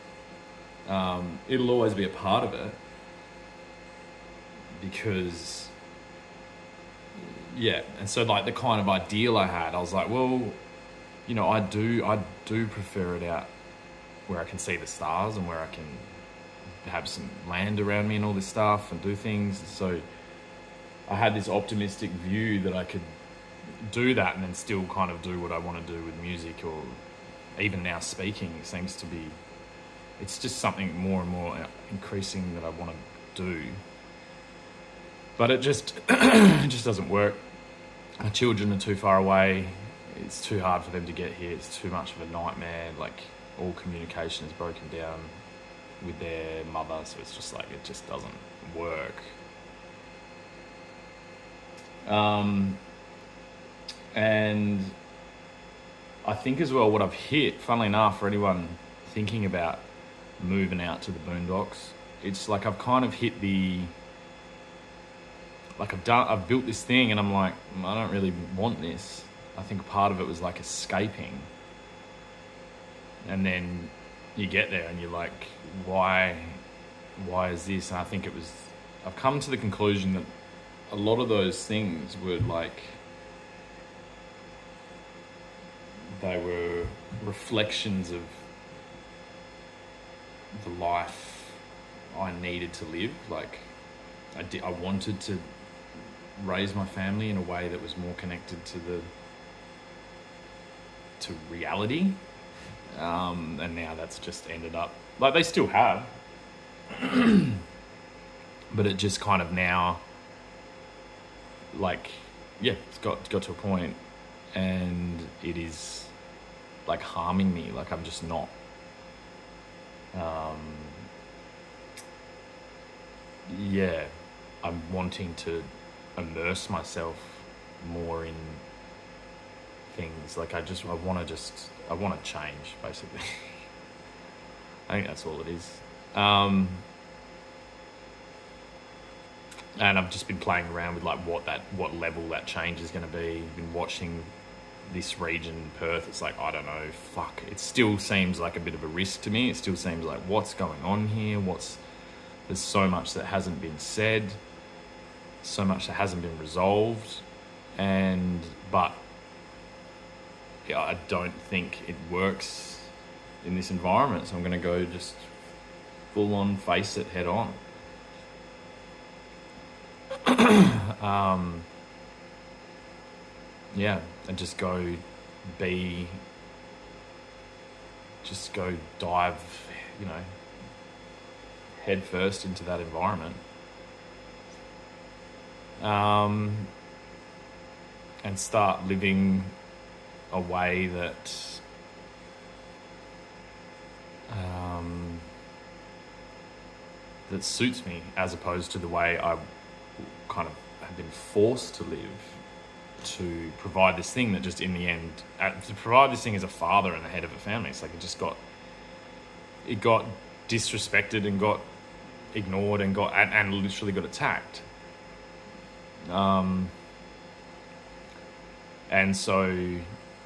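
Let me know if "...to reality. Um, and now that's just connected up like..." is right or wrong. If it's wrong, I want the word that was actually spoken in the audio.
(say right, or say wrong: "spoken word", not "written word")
wrong: "ended", not "connected".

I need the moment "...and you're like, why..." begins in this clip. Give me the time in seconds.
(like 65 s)
74 s.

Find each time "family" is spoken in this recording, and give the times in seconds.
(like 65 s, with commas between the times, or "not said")
96 s, 207 s.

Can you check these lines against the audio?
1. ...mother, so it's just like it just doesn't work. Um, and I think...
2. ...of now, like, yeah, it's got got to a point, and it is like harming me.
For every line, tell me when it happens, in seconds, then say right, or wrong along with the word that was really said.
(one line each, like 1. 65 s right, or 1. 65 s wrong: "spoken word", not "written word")
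1. 46 s right
2. 109 s right.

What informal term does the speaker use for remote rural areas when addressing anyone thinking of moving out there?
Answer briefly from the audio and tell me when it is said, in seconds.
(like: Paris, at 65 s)
The boondocks, at 61 s.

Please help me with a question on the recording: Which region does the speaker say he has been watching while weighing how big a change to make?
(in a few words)
Perth.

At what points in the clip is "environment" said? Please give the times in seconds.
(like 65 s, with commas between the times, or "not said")
163 s, 182 s.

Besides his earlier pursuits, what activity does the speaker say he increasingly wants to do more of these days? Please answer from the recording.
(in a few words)
Speaking.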